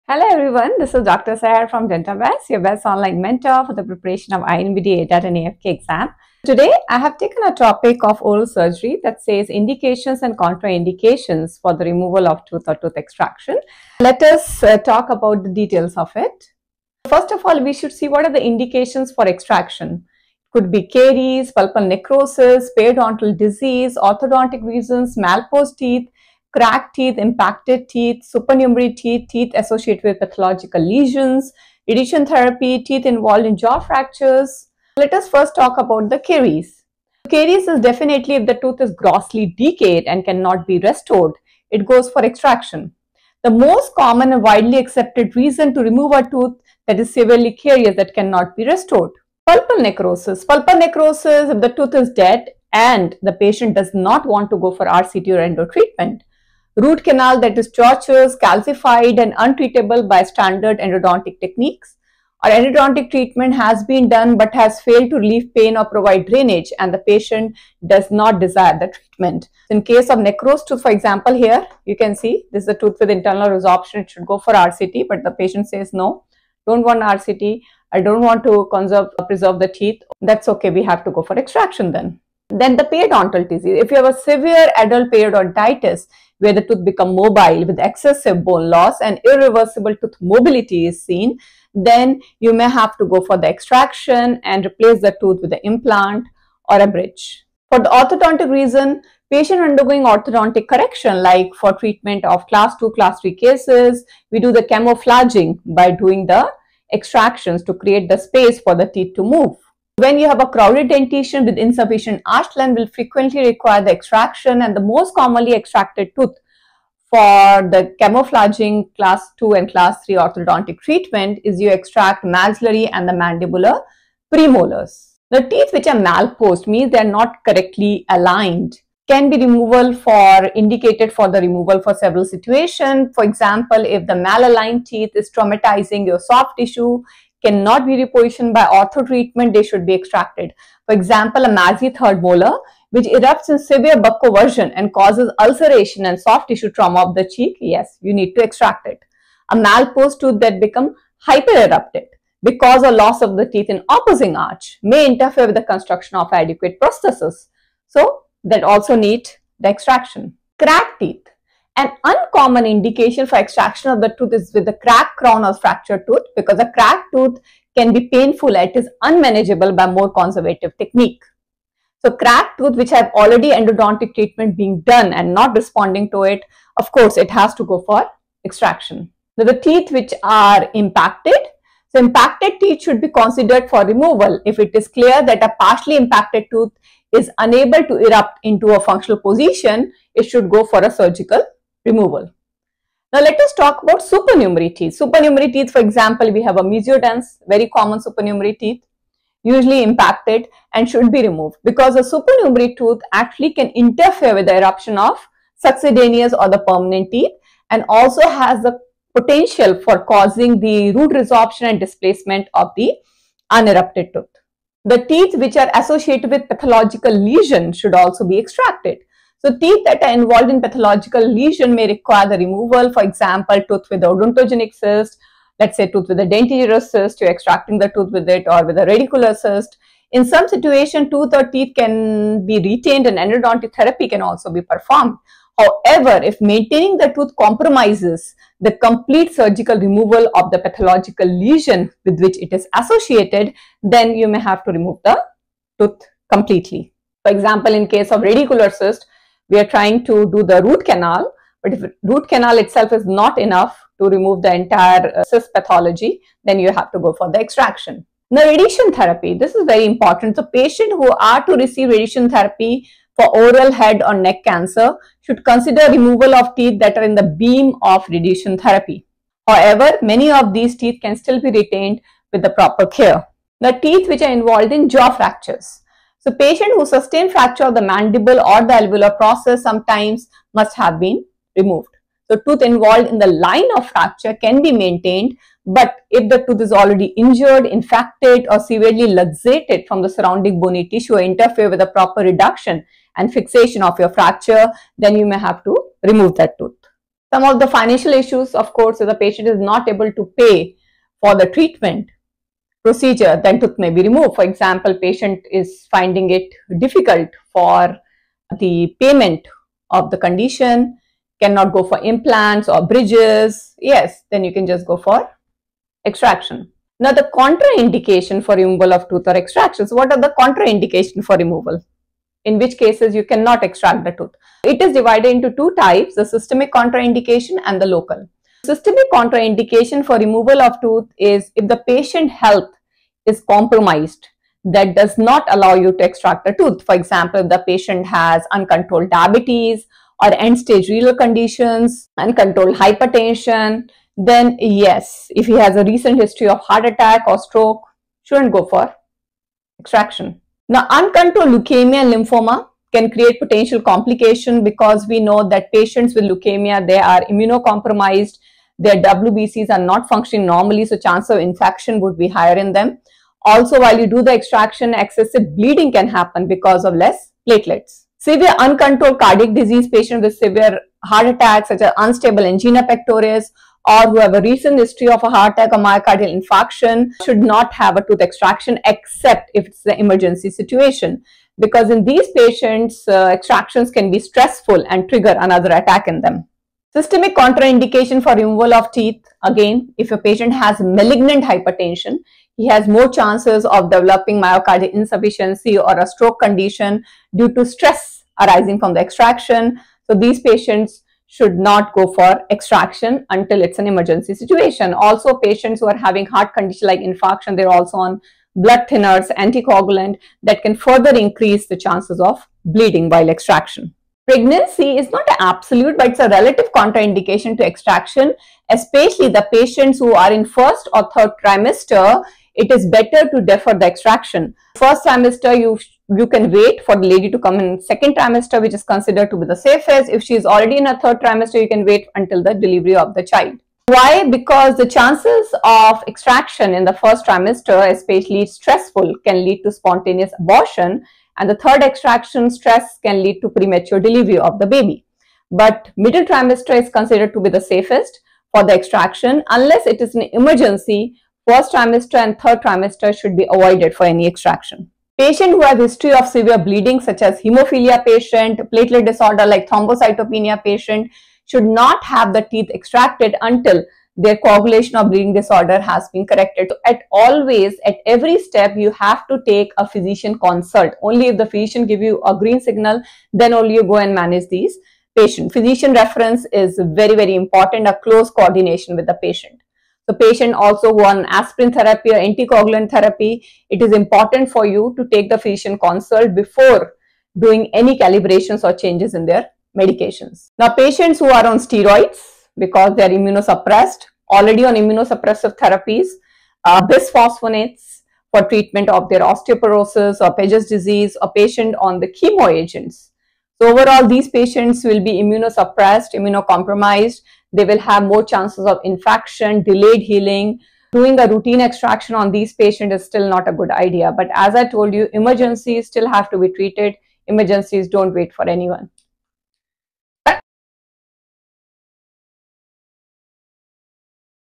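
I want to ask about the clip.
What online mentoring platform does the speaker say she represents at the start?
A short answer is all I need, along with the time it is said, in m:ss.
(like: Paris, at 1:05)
DentaBest, at 0:01.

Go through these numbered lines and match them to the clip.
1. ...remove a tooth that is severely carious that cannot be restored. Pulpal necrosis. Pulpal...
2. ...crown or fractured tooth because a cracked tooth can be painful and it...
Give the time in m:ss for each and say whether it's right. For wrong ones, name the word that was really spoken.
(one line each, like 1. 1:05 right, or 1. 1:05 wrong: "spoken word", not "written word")
1. 0:45 right
2. 2:45 right.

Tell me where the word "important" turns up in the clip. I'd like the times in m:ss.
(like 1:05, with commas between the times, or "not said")
4:19, 7:57, 8:03.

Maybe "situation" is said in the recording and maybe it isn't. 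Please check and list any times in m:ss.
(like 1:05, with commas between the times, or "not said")
2:12, 3:50, 6:20, 6:44.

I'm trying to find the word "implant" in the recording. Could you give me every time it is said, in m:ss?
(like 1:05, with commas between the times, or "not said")
1:35, 5:12.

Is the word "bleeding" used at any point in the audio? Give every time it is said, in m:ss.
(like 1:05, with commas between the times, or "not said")
6:05, 6:52, 7:36, 7:45.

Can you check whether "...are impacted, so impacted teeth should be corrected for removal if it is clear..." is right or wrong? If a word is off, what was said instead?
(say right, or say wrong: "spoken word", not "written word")
wrong: "considered", not "corrected".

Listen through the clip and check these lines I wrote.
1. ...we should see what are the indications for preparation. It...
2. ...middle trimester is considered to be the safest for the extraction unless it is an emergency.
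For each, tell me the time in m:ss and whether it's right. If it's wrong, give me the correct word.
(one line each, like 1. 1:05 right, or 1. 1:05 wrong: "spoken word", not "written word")
1. 0:17 wrong: "extraction", not "preparation"
2. 7:25 right.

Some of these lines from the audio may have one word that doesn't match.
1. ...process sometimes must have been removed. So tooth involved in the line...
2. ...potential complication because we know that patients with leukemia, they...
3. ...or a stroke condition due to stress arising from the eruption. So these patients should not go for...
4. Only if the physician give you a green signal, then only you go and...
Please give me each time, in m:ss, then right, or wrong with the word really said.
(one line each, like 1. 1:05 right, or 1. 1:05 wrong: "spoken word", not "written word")
1. 4:39 right
2. 5:53 right
3. 6:35 wrong: "extraction", not "eruption"
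4. 7:51 right.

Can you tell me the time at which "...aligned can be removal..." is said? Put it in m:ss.
2:08.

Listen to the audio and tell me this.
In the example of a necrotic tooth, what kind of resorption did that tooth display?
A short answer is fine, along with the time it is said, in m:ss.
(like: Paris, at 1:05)
Internal resorption, at 1:13.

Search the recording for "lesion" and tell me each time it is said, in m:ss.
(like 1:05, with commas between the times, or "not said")
0:30, 3:37, 3:41, 4:01.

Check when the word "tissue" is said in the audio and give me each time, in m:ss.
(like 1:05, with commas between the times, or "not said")
2:16, 2:26, 4:50.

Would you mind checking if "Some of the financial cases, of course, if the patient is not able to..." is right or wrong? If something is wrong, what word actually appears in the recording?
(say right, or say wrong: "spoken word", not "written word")
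wrong: "issues", not "cases".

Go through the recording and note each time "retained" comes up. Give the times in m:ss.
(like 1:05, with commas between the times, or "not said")
3:52, 4:31.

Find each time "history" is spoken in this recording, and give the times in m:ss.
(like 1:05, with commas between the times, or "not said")
5:46, 6:14, 7:35.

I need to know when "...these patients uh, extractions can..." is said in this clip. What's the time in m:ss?
6:22.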